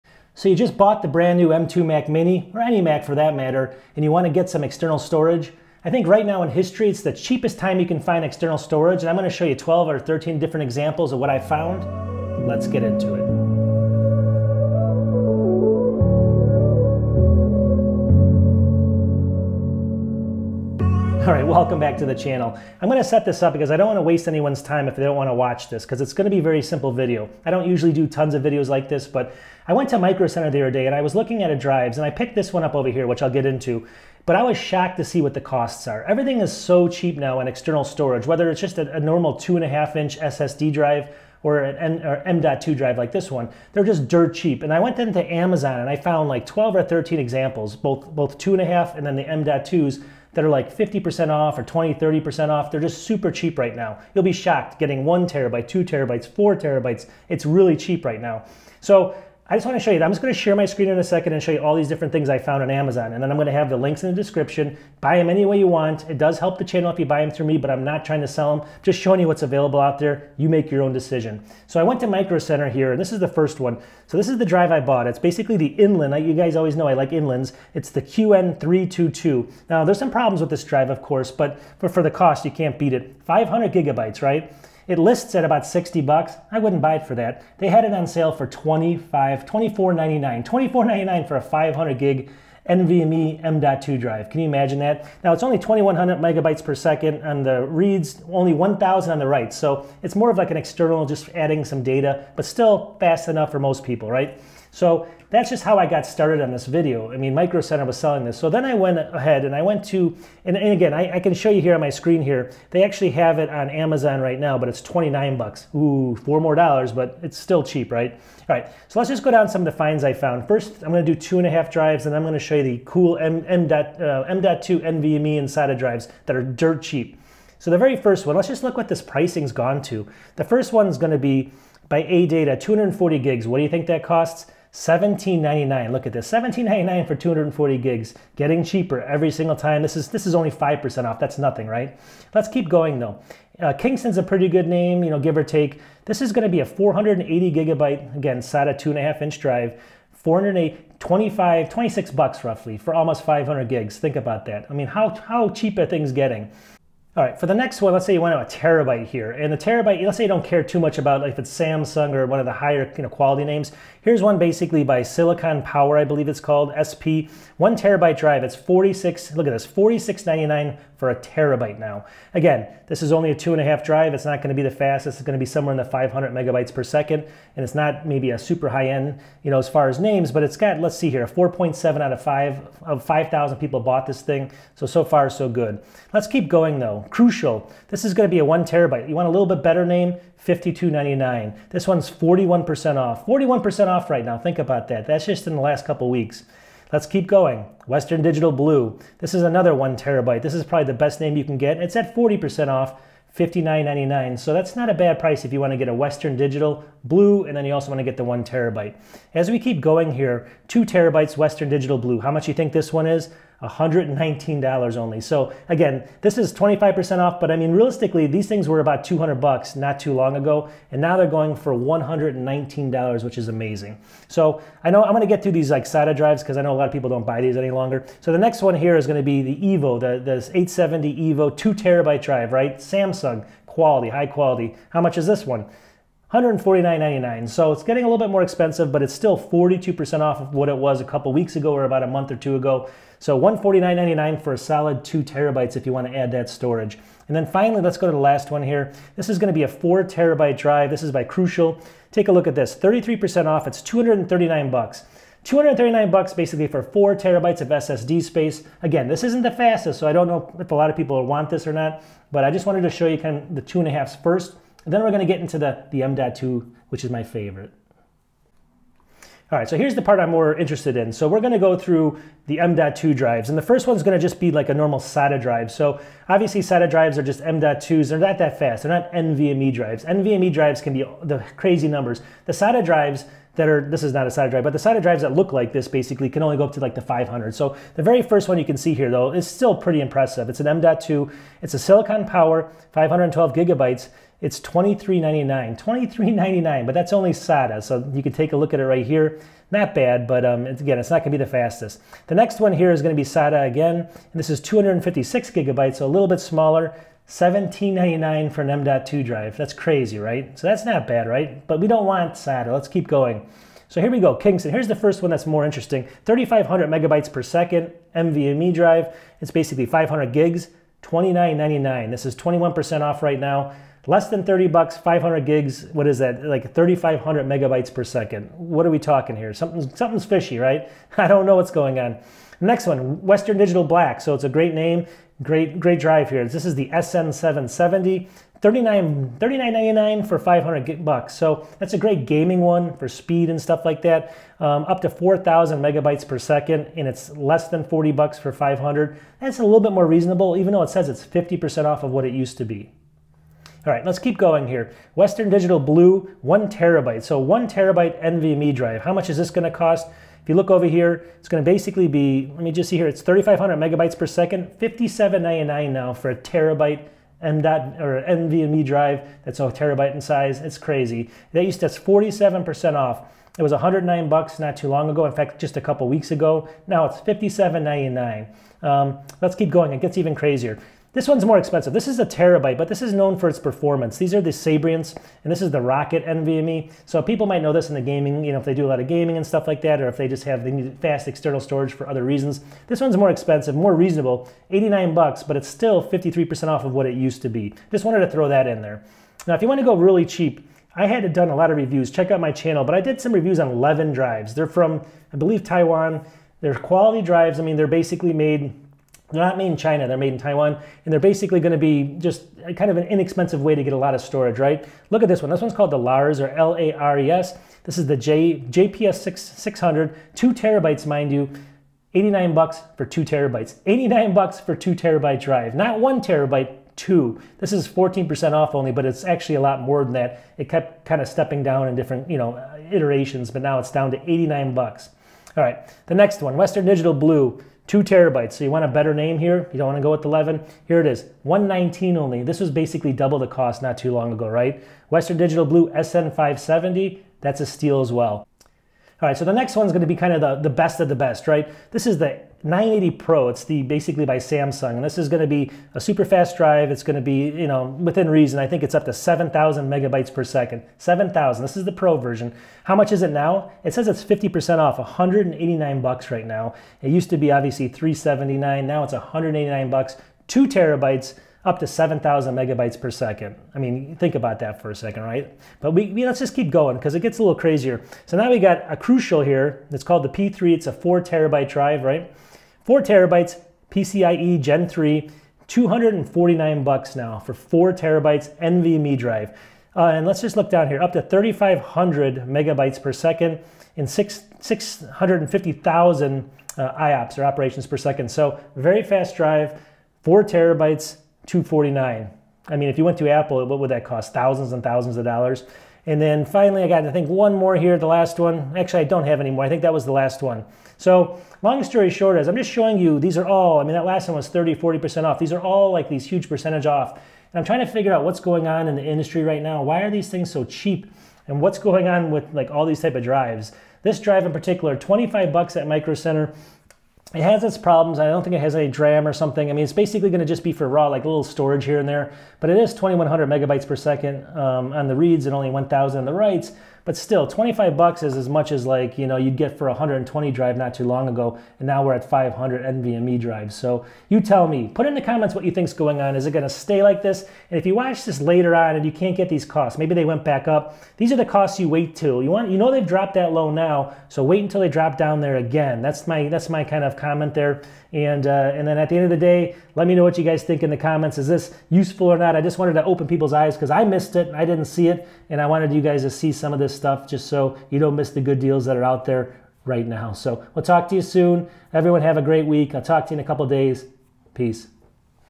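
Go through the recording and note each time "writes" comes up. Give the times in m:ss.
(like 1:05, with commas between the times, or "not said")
1:39, 8:56.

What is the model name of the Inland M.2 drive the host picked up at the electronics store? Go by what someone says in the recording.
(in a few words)
QN322.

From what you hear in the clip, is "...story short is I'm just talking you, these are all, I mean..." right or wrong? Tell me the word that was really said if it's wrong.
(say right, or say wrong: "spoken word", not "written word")
wrong: "showing", not "talking".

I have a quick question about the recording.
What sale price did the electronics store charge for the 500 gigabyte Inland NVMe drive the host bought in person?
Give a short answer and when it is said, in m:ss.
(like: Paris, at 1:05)
$24.99, at 1:29.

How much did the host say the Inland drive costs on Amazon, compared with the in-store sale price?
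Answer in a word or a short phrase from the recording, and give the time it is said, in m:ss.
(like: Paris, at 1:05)
$29, at 1:54.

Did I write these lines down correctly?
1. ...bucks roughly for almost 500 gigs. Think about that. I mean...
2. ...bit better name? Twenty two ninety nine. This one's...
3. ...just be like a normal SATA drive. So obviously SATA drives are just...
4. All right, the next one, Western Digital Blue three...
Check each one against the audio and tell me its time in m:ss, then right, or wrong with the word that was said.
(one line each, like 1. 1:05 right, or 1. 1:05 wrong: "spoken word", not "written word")
1. 2:32 right
2. 3:09 wrong: "Fifty", not "Twenty"
3. 4:34 right
4. 7:15 wrong: "two", not "three".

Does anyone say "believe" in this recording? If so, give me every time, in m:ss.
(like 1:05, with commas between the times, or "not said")
2:46, 6:45.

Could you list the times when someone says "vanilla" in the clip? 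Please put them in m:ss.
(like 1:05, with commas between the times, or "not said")
not said.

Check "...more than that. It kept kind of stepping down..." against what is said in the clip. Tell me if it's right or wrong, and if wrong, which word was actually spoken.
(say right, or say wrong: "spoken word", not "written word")
right.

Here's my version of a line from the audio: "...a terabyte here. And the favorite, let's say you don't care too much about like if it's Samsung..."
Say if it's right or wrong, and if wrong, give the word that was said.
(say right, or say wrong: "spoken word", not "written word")
wrong: "terabyte", not "favorite".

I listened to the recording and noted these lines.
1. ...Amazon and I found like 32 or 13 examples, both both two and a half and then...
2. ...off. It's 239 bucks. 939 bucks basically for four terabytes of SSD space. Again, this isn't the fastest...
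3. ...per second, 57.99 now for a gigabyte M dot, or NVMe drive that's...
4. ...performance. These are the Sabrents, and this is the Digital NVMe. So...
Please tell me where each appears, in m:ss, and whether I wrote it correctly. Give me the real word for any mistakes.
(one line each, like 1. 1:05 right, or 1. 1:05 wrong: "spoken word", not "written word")
1. 0:45 wrong: "12", not "32"
2. 4:13 wrong: "239", not "939"
3. 6:04 wrong: "terabyte", not "gigabyte"
4. 6:23 wrong: "Rocket", not "Digital".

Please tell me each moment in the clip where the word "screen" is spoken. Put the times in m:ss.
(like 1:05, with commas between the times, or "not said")
1:00, 1:51.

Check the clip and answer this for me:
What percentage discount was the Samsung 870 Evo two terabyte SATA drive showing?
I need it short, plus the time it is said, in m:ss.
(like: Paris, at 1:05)
42%, at 3:59.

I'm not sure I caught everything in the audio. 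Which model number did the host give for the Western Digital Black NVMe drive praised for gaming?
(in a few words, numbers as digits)
SN770.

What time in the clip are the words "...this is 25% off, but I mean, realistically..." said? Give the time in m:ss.
3:36.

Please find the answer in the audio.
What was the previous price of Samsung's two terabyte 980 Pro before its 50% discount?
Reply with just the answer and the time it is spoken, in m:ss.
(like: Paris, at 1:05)
$379, at 7:47.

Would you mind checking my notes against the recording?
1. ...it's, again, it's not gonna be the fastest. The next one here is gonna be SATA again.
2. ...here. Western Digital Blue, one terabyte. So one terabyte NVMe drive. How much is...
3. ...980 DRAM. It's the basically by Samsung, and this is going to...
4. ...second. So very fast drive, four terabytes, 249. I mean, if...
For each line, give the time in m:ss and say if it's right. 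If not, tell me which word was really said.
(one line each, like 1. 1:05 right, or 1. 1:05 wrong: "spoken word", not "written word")
1. 5:00 right
2. 5:54 right
3. 7:32 wrong: "Pro", not "DRAM"
4. 8:17 right.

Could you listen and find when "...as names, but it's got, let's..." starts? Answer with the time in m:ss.
2:59.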